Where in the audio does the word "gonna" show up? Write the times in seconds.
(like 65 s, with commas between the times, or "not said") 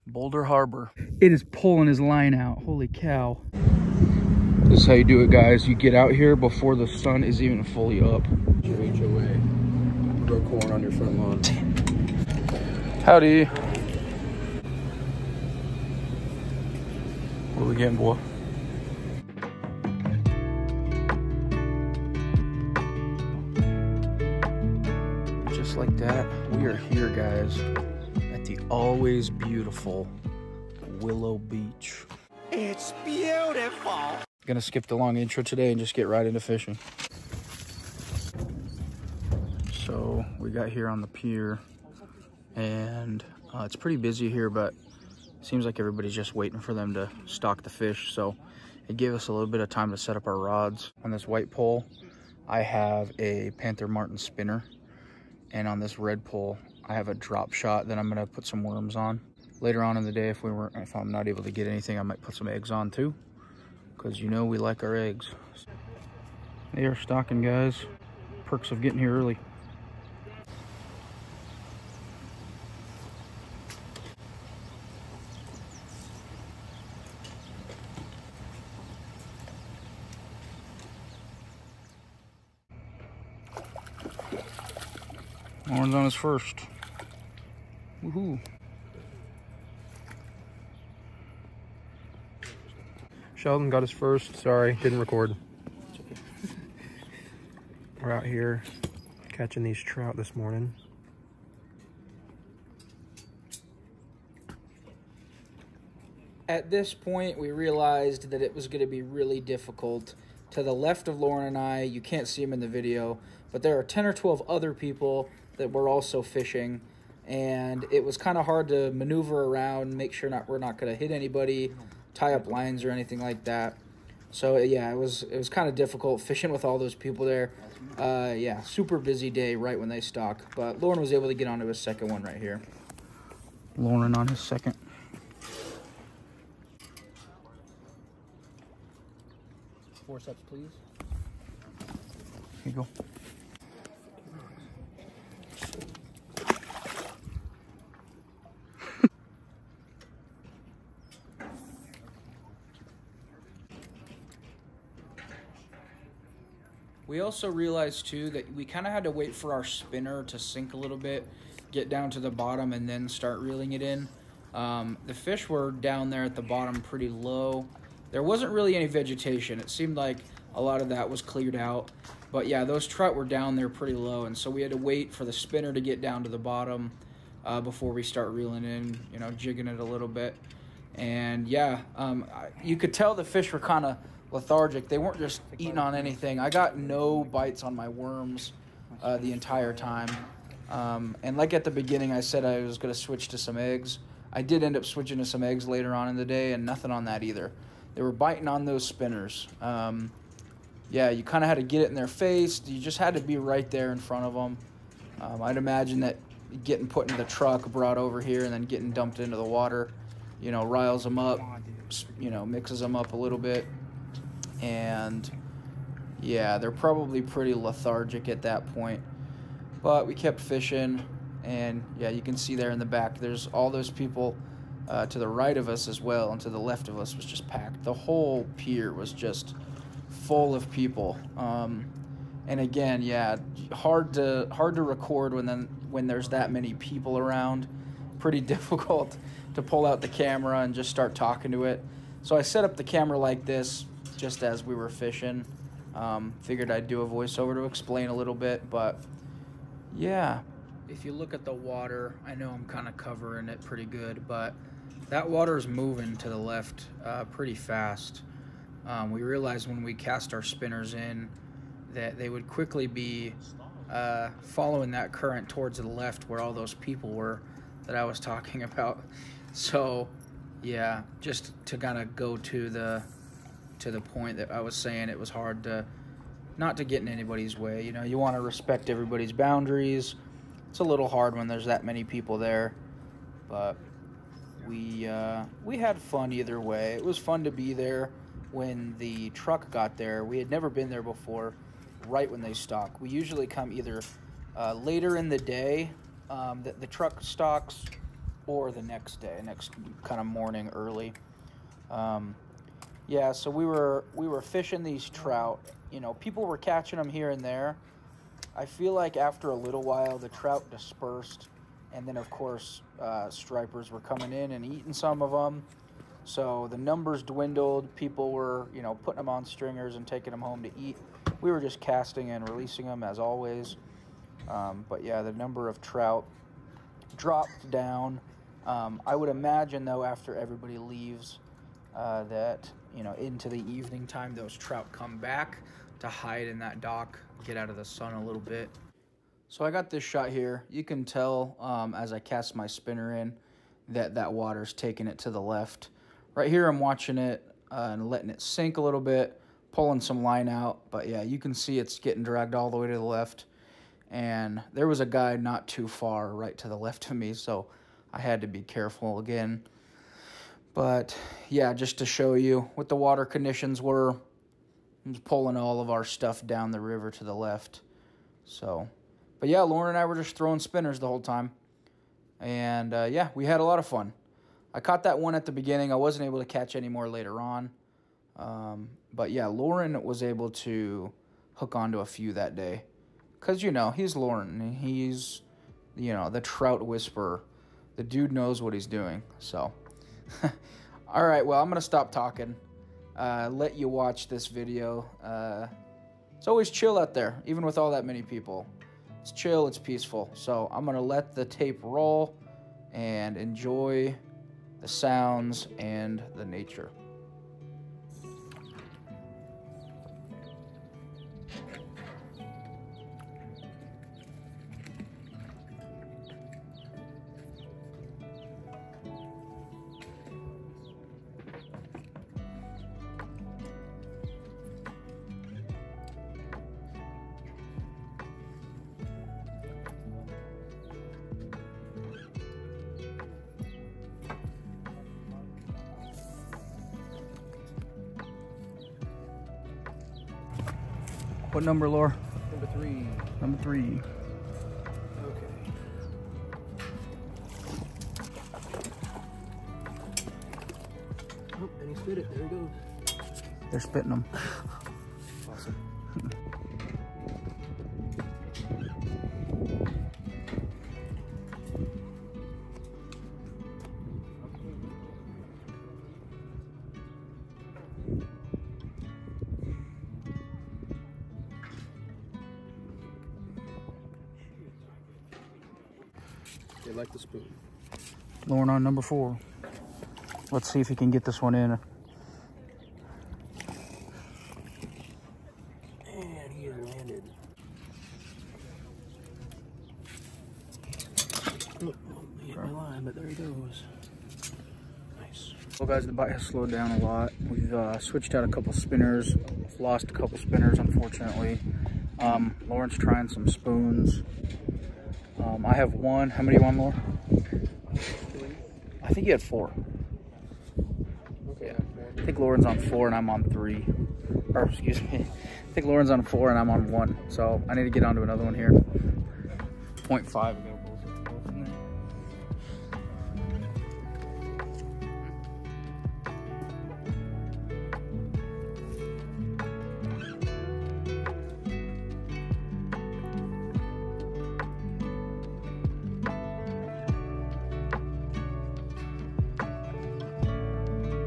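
34 s, 58 s.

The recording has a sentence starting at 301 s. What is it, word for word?
Um, yeah, so we were we were fishing these trout.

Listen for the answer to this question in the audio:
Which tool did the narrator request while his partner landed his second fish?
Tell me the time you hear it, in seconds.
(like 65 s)
140 s.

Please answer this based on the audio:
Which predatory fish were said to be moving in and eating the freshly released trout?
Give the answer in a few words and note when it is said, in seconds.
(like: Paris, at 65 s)
Stripers, at 313 s.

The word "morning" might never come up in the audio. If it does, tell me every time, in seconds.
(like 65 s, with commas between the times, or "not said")
100 s, 300 s.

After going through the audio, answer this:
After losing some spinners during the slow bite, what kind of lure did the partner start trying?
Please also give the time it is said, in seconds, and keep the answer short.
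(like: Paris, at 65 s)
Spoons, at 503 s.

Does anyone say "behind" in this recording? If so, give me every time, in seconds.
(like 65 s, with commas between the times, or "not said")
not said.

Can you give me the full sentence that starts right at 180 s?
And yeah, um, you could tell the fish were kind of lethargic.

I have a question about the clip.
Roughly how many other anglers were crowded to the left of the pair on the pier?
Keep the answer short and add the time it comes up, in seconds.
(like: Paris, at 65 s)
10 or 12, at 113 s.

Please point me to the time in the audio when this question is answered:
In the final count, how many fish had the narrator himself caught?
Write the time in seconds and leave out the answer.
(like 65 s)
516 s.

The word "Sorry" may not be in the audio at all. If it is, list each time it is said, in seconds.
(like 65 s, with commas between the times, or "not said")
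94 s.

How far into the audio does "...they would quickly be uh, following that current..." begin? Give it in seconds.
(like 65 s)
262 s.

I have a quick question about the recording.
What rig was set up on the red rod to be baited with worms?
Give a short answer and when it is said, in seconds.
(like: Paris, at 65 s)
Drop shot, at 57 s.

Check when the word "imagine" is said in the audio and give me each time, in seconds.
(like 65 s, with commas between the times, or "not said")
205 s, 329 s.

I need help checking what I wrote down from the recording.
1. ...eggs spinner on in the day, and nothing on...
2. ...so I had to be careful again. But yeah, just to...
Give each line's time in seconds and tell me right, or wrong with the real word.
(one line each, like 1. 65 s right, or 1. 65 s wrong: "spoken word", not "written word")
1. 195 s wrong: "later", not "spinner"
2. 357 s right.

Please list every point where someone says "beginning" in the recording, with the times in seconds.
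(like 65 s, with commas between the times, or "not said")
191 s, 375 s.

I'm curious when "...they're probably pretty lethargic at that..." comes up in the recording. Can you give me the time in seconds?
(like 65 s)
216 s.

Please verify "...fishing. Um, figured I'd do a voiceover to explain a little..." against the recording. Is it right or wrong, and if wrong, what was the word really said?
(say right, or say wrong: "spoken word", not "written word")
right.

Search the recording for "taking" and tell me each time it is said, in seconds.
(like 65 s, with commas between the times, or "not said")
320 s, 344 s.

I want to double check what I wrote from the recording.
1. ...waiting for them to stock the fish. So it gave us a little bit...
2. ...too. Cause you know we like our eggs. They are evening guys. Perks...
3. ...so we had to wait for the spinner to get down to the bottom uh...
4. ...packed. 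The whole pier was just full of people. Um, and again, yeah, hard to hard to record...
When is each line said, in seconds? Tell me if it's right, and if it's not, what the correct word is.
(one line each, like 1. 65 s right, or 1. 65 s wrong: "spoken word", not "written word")
1. 46 s right
2. 62 s wrong: "stocking", not "evening"
3. 174 s right
4. 227 s right.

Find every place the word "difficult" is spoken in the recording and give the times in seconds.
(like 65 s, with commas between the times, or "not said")
109 s, 125 s, 238 s.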